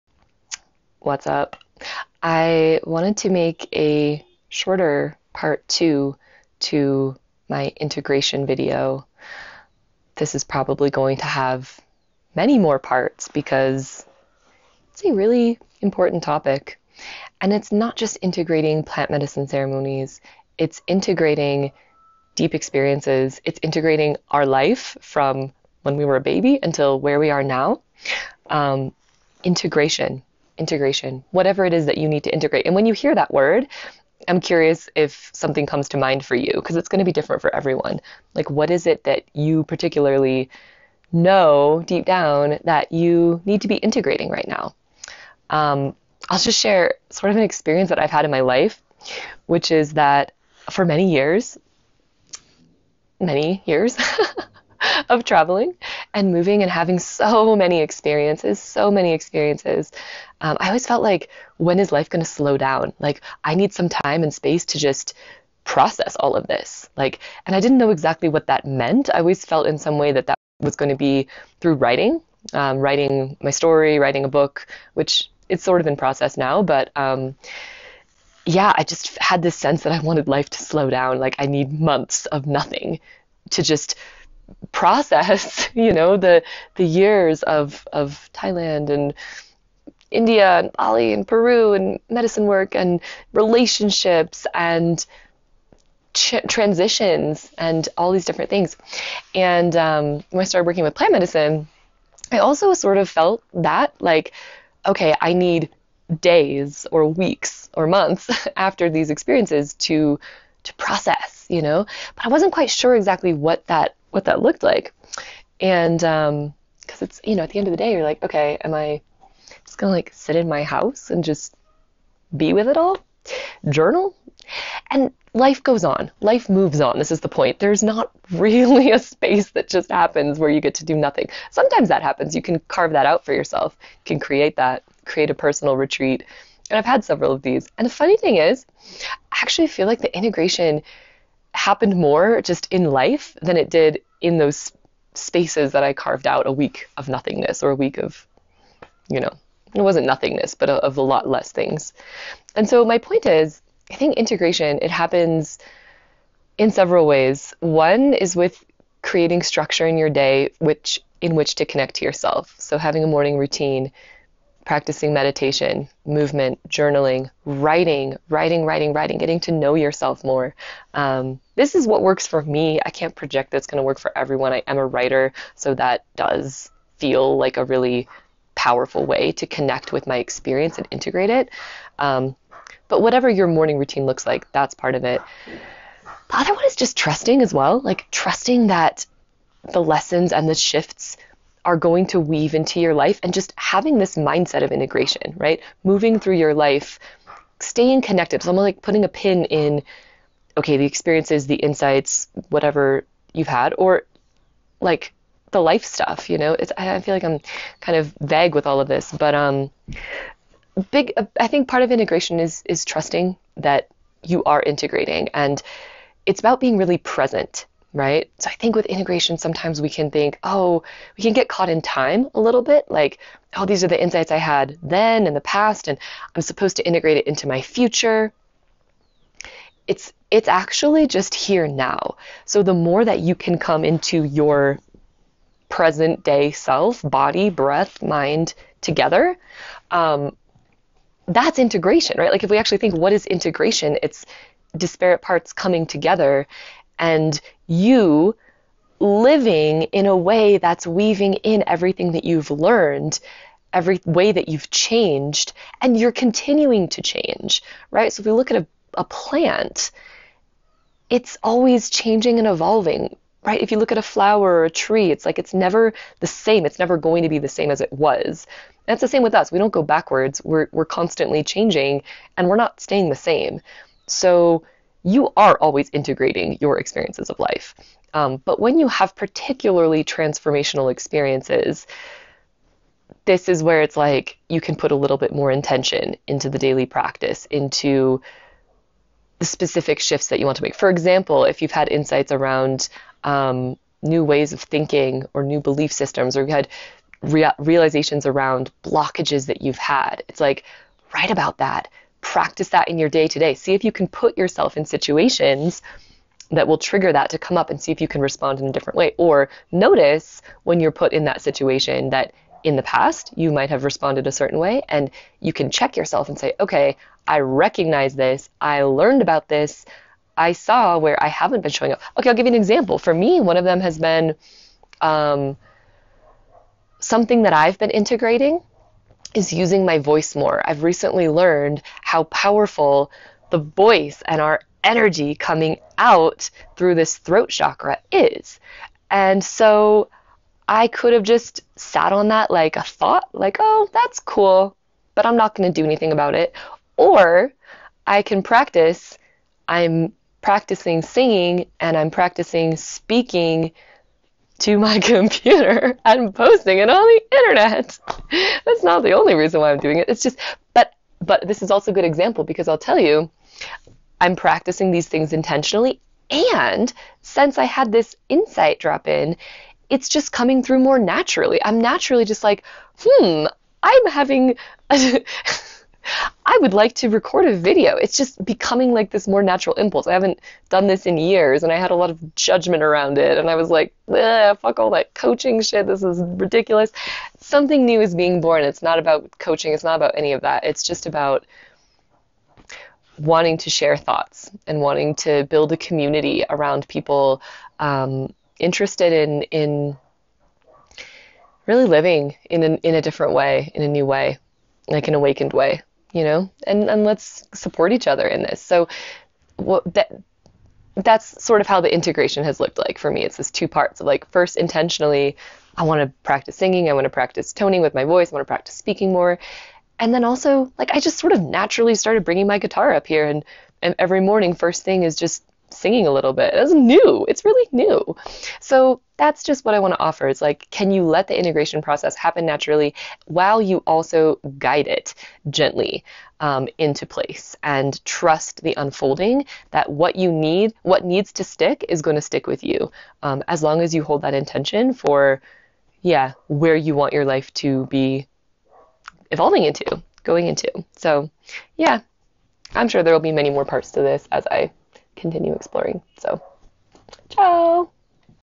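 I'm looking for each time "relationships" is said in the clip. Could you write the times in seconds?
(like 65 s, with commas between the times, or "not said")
93 s.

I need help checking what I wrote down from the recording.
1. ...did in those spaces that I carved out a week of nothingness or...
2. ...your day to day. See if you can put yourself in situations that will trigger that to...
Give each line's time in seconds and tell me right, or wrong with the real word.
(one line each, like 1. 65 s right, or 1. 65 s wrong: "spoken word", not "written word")
1. 143 s right
2. 302 s right.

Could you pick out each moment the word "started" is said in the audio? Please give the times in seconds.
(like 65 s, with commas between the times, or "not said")
100 s, 421 s.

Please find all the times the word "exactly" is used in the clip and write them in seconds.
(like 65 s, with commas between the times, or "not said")
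67 s, 112 s.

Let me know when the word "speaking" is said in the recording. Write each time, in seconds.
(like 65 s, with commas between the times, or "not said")
352 s, 418 s.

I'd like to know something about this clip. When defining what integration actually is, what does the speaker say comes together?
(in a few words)
Disparate parts.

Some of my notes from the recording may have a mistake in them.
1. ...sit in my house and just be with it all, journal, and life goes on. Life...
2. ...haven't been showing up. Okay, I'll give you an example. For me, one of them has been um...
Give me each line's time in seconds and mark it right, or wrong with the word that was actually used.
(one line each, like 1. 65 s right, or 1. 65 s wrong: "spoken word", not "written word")
1. 120 s right
2. 321 s right.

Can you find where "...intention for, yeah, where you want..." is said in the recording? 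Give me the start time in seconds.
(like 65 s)
444 s.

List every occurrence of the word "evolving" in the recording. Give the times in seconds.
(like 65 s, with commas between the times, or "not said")
262 s, 449 s.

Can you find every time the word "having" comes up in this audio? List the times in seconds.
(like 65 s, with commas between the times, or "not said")
56 s, 162 s, 193 s, 374 s.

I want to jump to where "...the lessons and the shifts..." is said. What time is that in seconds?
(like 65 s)
189 s.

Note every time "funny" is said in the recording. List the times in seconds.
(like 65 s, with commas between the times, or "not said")
137 s.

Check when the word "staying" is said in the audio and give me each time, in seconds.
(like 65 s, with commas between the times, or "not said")
197 s, 272 s.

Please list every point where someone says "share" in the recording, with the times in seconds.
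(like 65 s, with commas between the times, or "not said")
46 s, 393 s.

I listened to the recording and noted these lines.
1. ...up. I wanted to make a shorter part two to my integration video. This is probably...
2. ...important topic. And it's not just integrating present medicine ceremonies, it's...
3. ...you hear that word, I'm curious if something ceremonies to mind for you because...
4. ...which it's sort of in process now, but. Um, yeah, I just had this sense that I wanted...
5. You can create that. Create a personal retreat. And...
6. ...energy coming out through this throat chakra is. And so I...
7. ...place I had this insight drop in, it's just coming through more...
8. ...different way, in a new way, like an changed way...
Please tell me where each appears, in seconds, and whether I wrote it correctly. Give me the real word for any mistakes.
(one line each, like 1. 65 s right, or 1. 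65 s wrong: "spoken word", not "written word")
1. 1 s right
2. 15 s wrong: "plant", not "present"
3. 32 s wrong: "comes", not "ceremonies"
4. 74 s right
5. 133 s right
6. 334 s right
7. 367 s wrong: "since", not "place"
8. 403 s wrong: "awakened", not "changed".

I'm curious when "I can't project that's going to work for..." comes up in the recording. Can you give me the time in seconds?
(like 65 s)
172 s.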